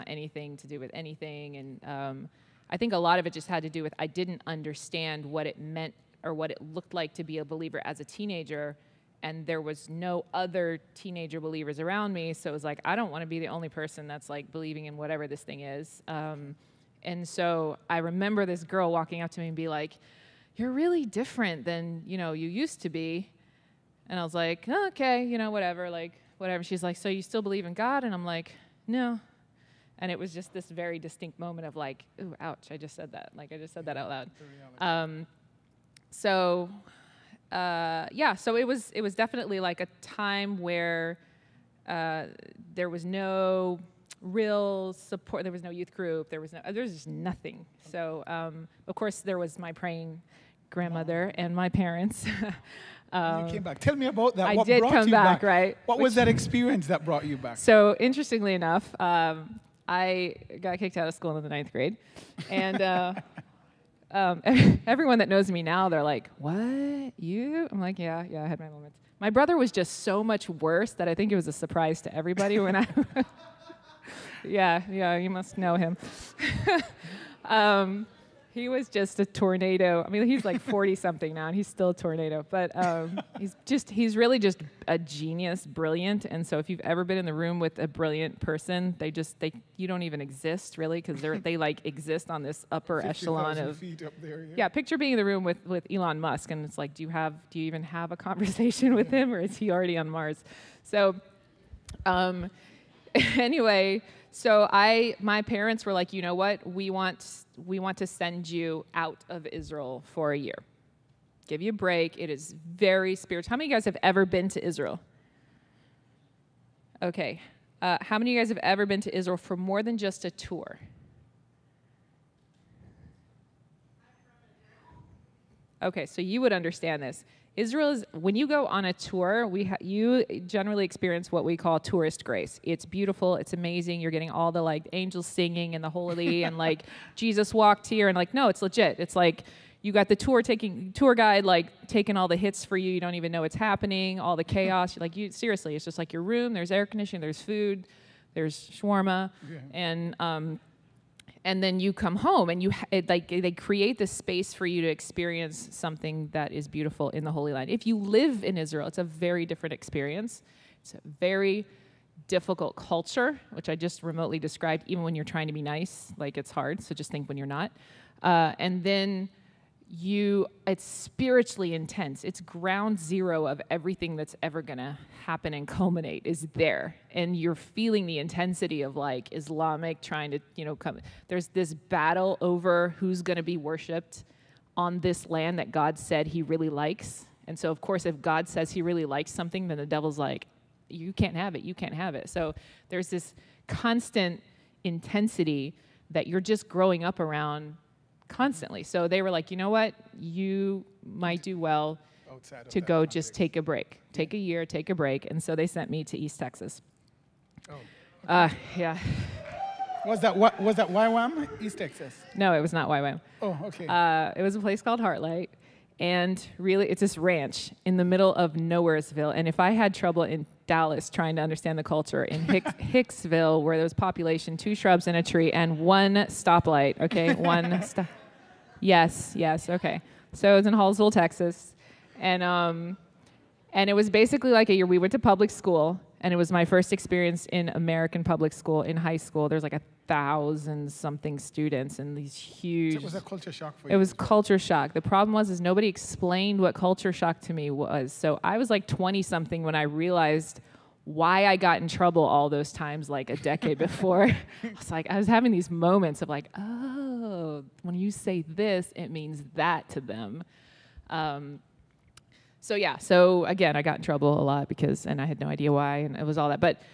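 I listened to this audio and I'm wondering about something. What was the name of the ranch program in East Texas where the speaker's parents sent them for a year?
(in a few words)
Heartlight.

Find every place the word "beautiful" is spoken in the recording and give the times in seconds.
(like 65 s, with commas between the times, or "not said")
132 s, 156 s.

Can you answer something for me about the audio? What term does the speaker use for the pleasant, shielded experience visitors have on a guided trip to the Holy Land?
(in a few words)
tourist grace.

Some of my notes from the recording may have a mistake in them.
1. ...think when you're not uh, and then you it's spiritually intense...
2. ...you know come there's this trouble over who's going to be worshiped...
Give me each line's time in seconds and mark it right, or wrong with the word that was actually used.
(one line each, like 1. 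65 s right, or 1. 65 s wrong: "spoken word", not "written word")
1. 167 s right
2. 180 s wrong: "battle", not "trouble".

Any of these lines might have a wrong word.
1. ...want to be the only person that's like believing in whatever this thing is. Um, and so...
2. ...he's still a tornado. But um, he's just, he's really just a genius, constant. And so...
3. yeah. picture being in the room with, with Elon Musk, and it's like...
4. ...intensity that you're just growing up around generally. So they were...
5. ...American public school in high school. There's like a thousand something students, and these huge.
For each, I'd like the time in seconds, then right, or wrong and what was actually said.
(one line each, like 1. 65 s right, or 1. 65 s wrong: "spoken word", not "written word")
1. 13 s right
2. 81 s wrong: "brilliant", not "constant"
3. 94 s right
4. 194 s wrong: "constantly", not "generally"
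5. 237 s right.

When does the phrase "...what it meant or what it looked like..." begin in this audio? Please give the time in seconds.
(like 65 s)
5 s.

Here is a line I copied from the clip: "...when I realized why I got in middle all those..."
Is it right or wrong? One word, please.
wrong.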